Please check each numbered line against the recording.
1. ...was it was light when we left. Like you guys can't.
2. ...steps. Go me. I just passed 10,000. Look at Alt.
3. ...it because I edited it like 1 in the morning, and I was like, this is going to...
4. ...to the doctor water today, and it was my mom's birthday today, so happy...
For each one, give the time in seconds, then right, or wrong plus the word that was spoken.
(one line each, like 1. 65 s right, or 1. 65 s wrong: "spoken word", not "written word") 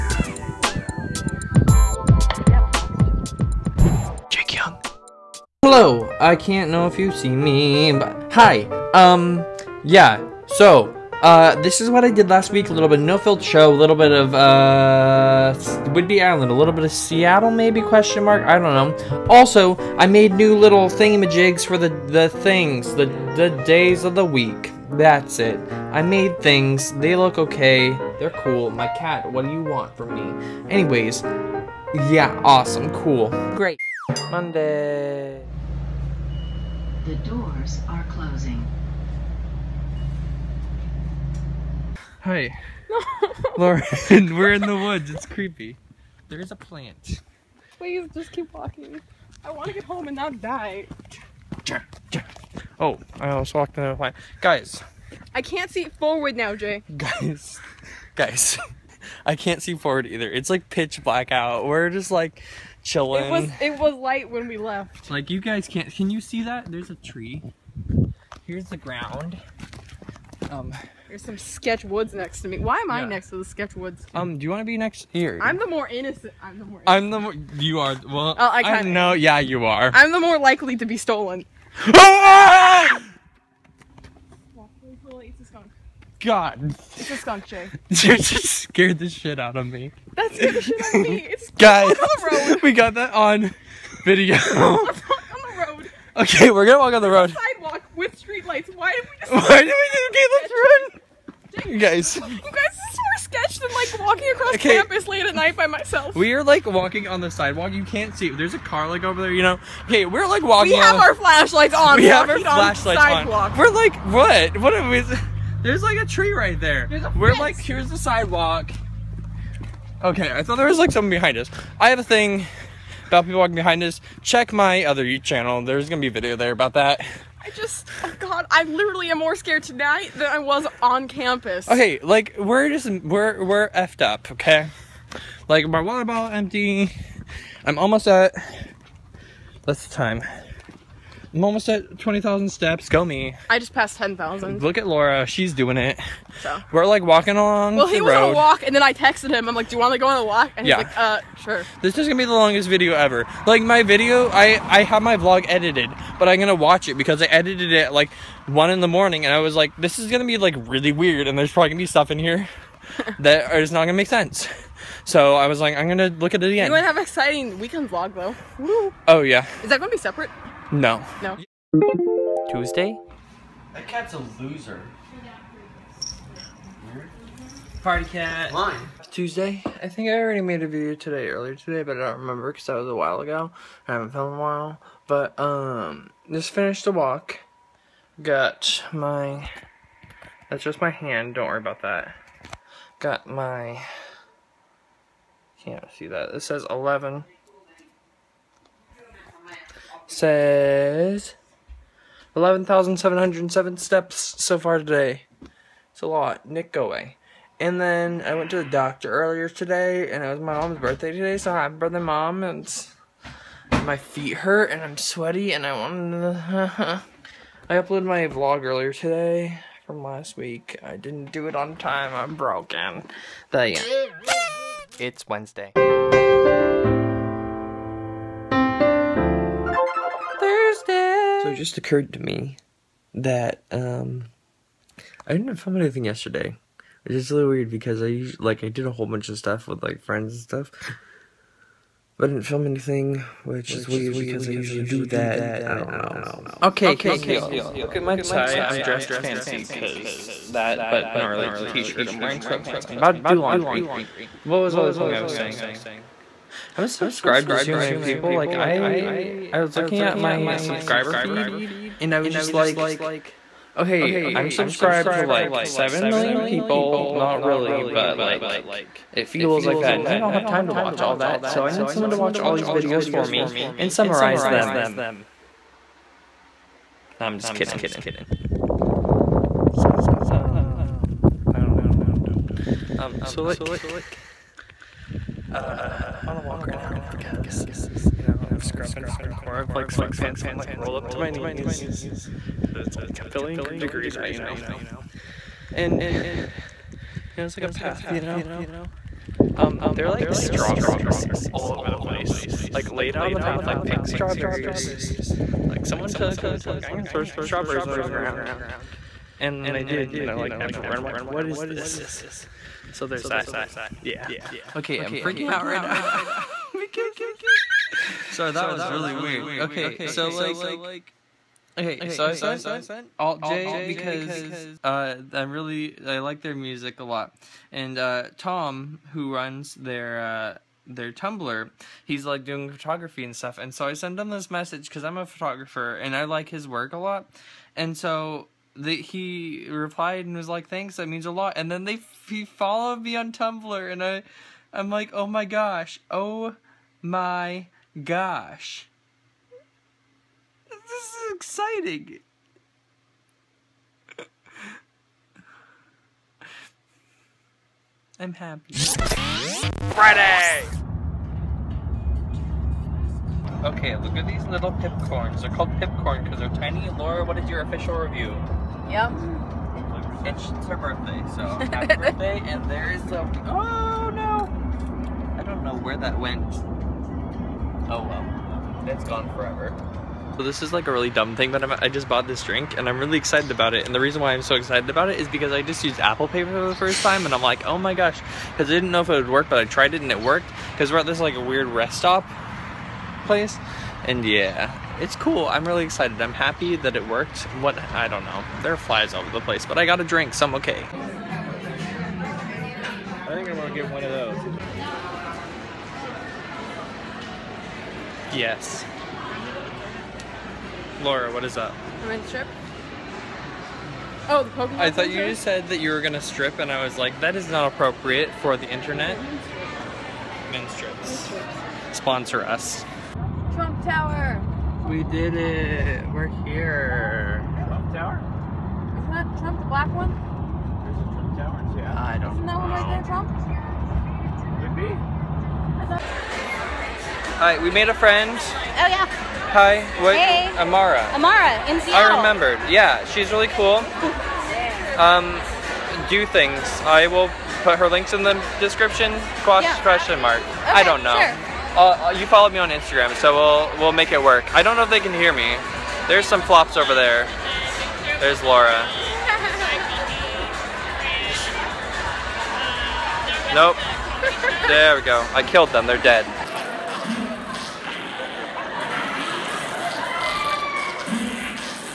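1. 63 s right
2. 142 s wrong: "Laura", not "Alt"
3. 156 s right
4. 208 s wrong: "earlier", not "water".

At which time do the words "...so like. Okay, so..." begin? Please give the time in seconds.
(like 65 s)
320 s.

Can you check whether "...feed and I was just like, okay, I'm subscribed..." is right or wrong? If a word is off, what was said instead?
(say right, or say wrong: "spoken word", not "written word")
right.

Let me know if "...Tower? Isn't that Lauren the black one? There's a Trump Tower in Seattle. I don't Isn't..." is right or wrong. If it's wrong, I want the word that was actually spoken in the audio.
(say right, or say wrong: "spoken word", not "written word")
wrong: "Trump", not "Lauren".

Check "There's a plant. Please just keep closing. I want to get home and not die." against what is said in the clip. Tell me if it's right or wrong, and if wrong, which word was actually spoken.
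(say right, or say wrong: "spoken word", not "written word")
wrong: "walking", not "closing".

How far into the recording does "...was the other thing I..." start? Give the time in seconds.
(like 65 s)
254 s.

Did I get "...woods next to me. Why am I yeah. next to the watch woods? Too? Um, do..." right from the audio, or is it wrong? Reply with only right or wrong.
wrong.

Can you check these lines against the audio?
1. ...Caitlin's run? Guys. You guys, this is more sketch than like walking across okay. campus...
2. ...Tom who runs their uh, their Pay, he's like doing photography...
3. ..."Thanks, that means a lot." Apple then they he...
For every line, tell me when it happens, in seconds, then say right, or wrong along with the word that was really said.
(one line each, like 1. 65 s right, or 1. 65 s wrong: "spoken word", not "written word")
1. 100 s right
2. 328 s wrong: "Tumblr", not "Pay"
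3. 340 s wrong: "And", not "Apple".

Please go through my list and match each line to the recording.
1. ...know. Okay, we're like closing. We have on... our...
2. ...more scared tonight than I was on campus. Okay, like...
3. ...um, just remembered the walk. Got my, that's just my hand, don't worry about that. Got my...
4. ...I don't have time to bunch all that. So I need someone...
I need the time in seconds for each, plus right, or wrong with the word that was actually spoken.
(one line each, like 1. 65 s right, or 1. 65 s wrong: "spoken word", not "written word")
1. 109 s wrong: "walking", not "closing"
2. 129 s right
3. 185 s wrong: "finished", not "remembered"
4. 270 s wrong: "watch", not "bunch".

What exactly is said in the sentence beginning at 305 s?
Like someone took and was like, I'm gonna throw some strawberries on the ground.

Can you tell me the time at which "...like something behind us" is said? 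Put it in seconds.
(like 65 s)
120 s.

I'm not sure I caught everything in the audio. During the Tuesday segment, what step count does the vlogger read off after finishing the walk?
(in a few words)
11,707.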